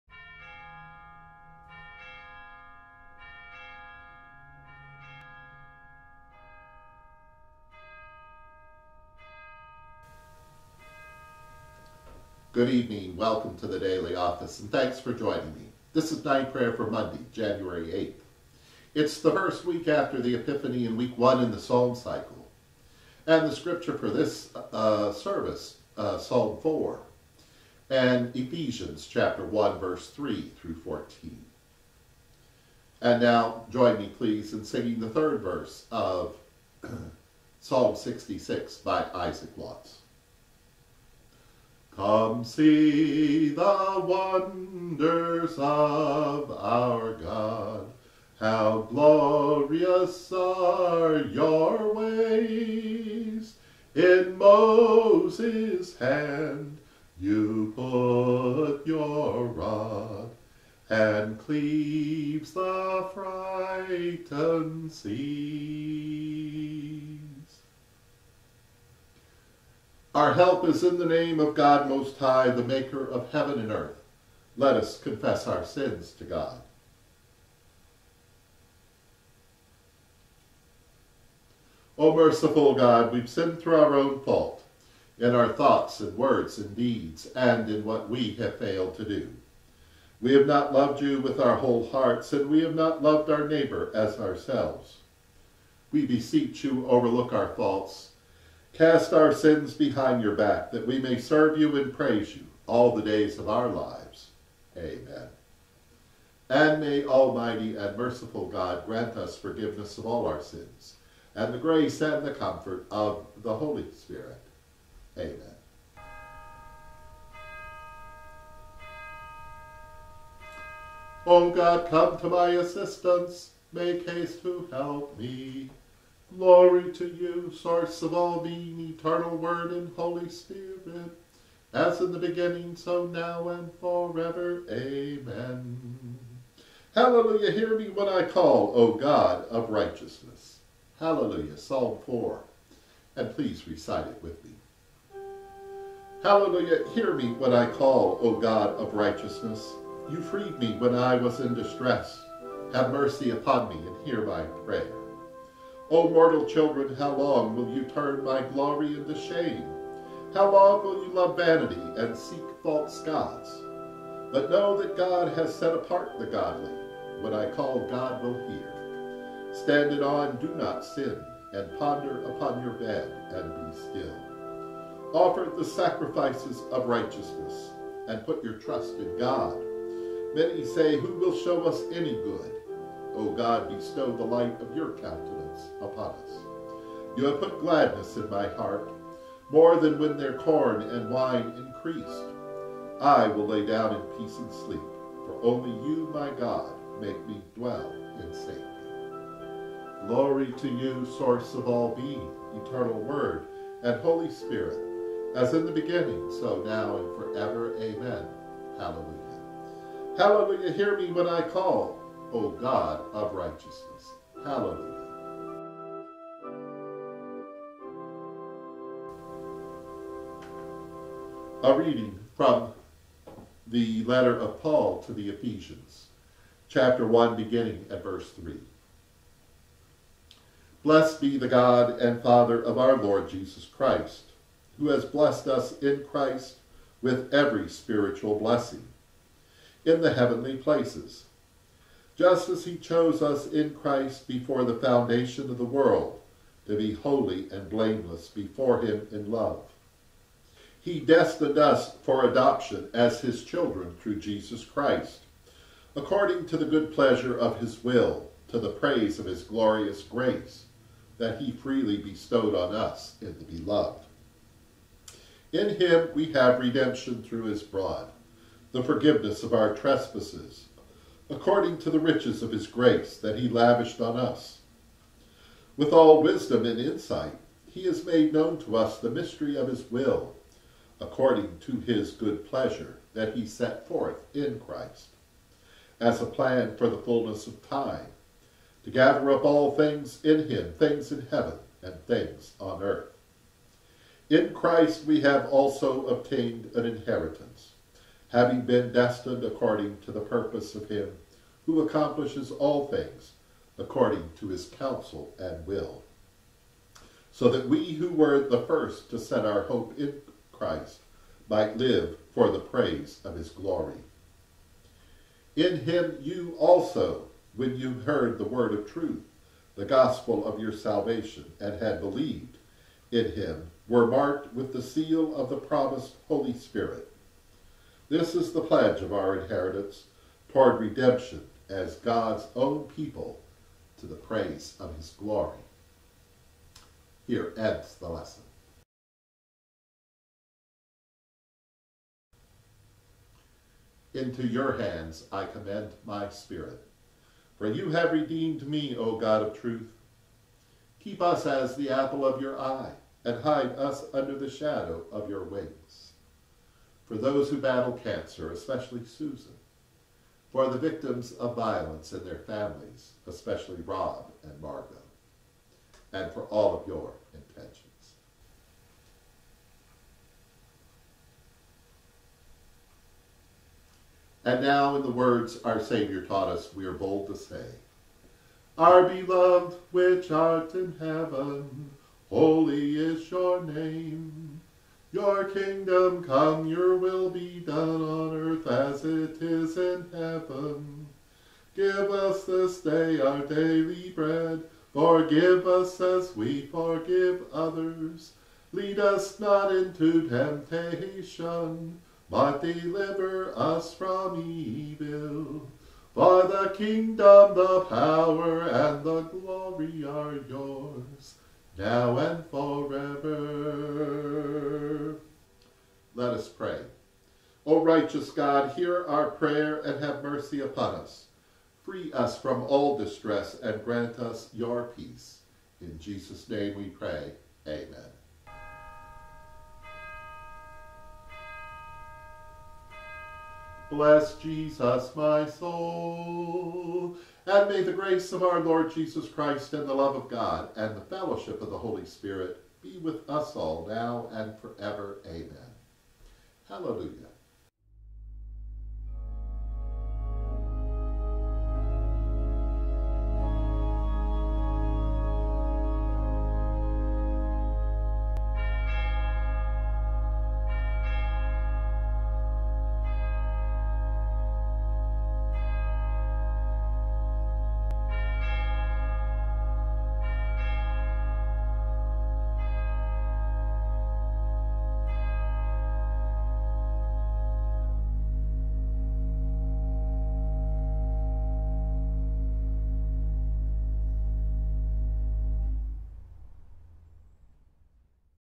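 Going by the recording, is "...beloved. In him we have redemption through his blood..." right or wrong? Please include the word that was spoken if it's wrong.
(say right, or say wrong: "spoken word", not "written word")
right.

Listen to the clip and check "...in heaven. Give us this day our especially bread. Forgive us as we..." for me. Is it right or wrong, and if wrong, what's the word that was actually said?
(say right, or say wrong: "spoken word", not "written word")
wrong: "daily", not "especially".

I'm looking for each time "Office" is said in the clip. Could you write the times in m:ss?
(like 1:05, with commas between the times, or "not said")
0:14.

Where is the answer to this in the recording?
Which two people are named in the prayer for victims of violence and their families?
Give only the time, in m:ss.
6:03.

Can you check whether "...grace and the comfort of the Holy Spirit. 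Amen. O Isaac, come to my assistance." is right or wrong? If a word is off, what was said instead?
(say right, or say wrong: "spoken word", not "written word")
wrong: "God", not "Isaac".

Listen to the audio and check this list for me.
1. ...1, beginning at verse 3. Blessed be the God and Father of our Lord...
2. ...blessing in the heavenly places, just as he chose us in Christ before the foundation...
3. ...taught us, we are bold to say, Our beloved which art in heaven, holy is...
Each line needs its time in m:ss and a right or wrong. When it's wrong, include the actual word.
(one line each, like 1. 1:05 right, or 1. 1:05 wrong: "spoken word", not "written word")
1. 3:47 right
2. 3:58 right
3. 6:16 right.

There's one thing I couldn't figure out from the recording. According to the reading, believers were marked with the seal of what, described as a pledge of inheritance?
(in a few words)
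promised Holy Spirit.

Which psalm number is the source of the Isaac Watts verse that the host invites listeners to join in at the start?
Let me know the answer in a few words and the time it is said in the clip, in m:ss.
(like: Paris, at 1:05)
66, at 0:37.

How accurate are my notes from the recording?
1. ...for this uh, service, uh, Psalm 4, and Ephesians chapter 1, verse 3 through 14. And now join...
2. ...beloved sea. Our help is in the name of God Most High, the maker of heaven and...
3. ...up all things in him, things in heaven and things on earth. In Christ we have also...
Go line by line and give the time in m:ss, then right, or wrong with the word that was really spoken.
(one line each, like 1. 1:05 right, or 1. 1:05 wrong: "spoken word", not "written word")
1. 0:23 right
2. 1:03 wrong: "frightened", not "beloved"
3. 4:49 right.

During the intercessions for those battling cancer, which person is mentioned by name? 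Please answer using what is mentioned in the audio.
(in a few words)
Susan.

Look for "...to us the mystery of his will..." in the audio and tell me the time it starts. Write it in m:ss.
4:38.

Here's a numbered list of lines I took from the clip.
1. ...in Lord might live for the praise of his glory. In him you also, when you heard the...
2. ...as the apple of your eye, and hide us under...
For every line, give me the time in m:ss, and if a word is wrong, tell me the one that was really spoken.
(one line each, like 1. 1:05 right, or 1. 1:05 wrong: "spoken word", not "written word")
1. 5:09 wrong: "Christ", not "Lord"
2. 5:51 right.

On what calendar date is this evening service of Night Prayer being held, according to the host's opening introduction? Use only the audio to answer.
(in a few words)
Monday, January 8th.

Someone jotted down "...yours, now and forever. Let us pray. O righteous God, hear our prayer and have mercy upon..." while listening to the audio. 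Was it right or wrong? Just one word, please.
right.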